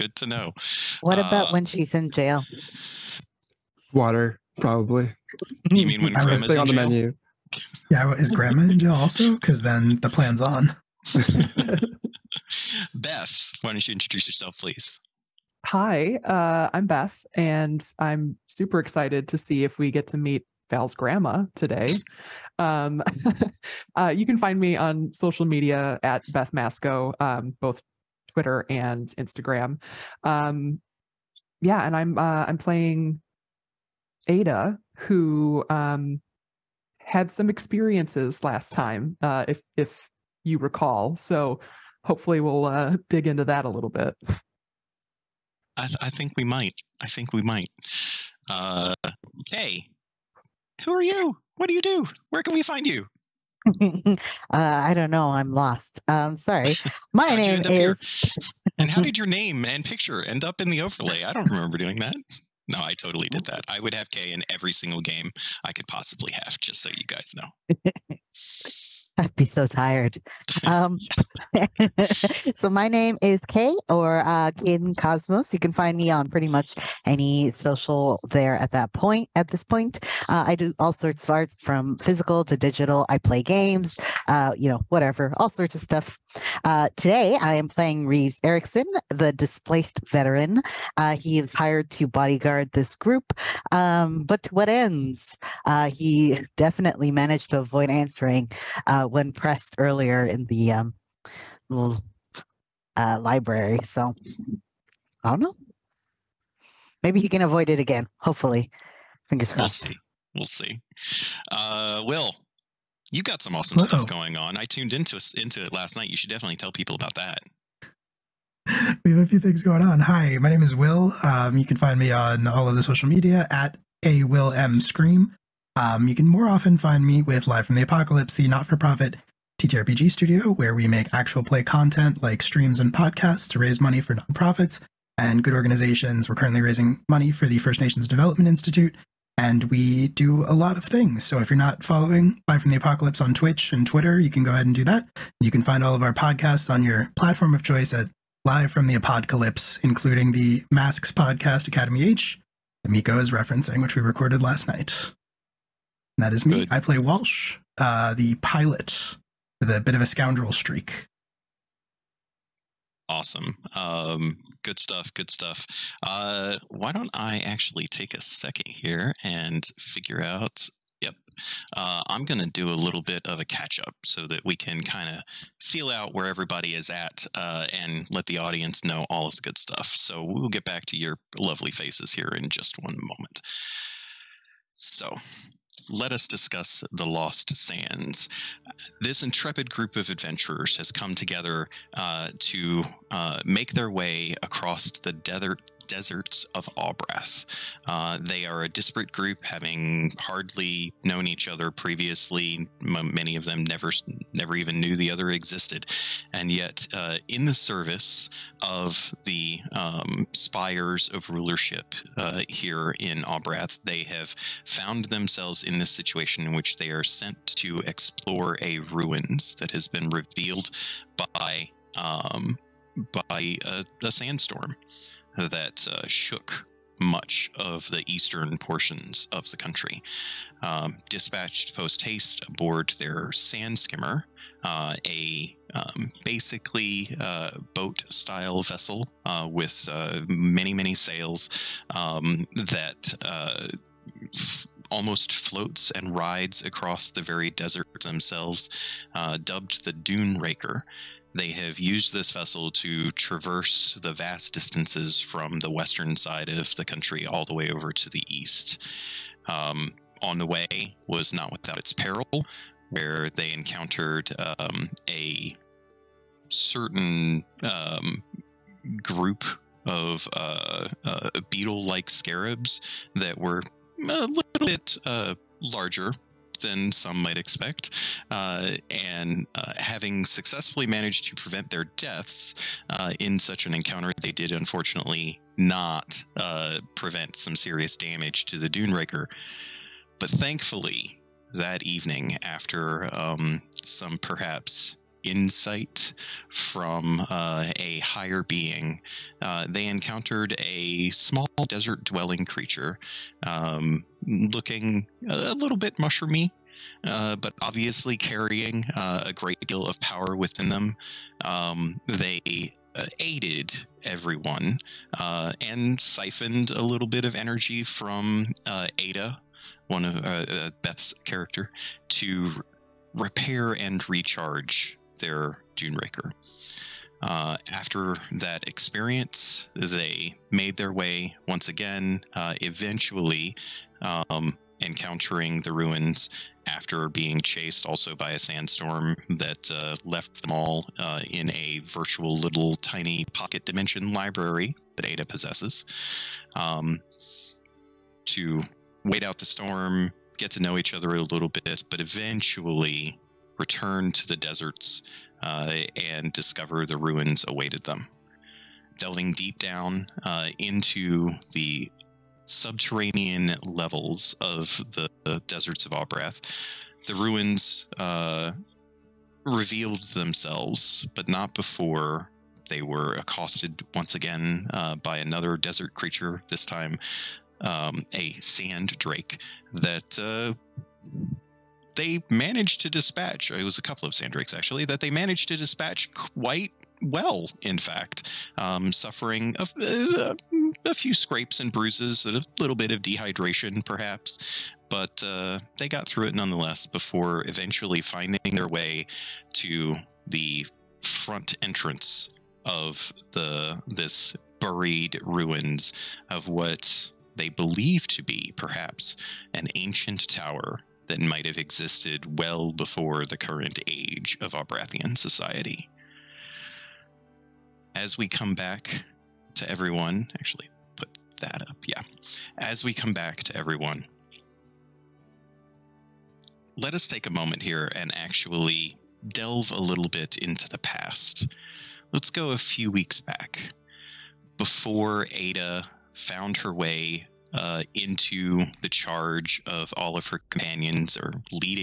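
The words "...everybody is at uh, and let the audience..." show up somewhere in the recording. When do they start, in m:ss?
2:56.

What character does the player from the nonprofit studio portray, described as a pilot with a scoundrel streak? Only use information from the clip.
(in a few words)
Walsh.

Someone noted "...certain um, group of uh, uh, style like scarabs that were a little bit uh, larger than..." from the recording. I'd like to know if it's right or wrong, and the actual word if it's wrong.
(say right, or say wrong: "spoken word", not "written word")
wrong: "beetle", not "style".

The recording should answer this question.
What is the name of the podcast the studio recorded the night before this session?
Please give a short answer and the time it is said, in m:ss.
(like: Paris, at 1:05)
Academy H, at 2:31.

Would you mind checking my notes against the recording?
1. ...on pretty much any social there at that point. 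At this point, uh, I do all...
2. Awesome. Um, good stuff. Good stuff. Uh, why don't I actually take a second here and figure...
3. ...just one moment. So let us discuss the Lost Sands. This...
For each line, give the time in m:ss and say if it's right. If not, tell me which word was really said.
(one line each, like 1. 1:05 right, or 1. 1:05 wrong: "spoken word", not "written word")
1. 1:16 right
2. 2:43 right
3. 3:02 right.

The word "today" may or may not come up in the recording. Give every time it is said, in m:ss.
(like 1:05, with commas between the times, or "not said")
0:21, 1:26.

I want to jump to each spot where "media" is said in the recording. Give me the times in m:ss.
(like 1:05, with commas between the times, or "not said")
0:25, 2:03.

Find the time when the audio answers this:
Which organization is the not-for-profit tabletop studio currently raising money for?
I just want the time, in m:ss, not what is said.
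2:17.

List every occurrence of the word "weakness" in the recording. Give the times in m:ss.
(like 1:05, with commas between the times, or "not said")
not said.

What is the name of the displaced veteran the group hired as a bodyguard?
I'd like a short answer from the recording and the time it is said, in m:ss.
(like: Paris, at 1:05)
Reeves Erickson, at 1:28.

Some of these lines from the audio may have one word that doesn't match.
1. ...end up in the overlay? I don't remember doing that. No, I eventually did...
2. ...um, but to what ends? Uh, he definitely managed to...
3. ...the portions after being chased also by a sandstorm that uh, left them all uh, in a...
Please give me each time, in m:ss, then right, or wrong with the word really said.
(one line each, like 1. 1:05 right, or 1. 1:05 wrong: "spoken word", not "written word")
1. 1:00 wrong: "totally", not "eventually"
2. 1:33 right
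3. 5:35 wrong: "ruins", not "portions".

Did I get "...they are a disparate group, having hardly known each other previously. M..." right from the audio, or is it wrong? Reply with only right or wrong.
right.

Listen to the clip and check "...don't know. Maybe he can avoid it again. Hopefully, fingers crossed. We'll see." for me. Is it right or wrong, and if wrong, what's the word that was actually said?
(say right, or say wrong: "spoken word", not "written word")
right.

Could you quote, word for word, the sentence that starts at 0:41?
So hopefully we'll uh, dig into that a little bit.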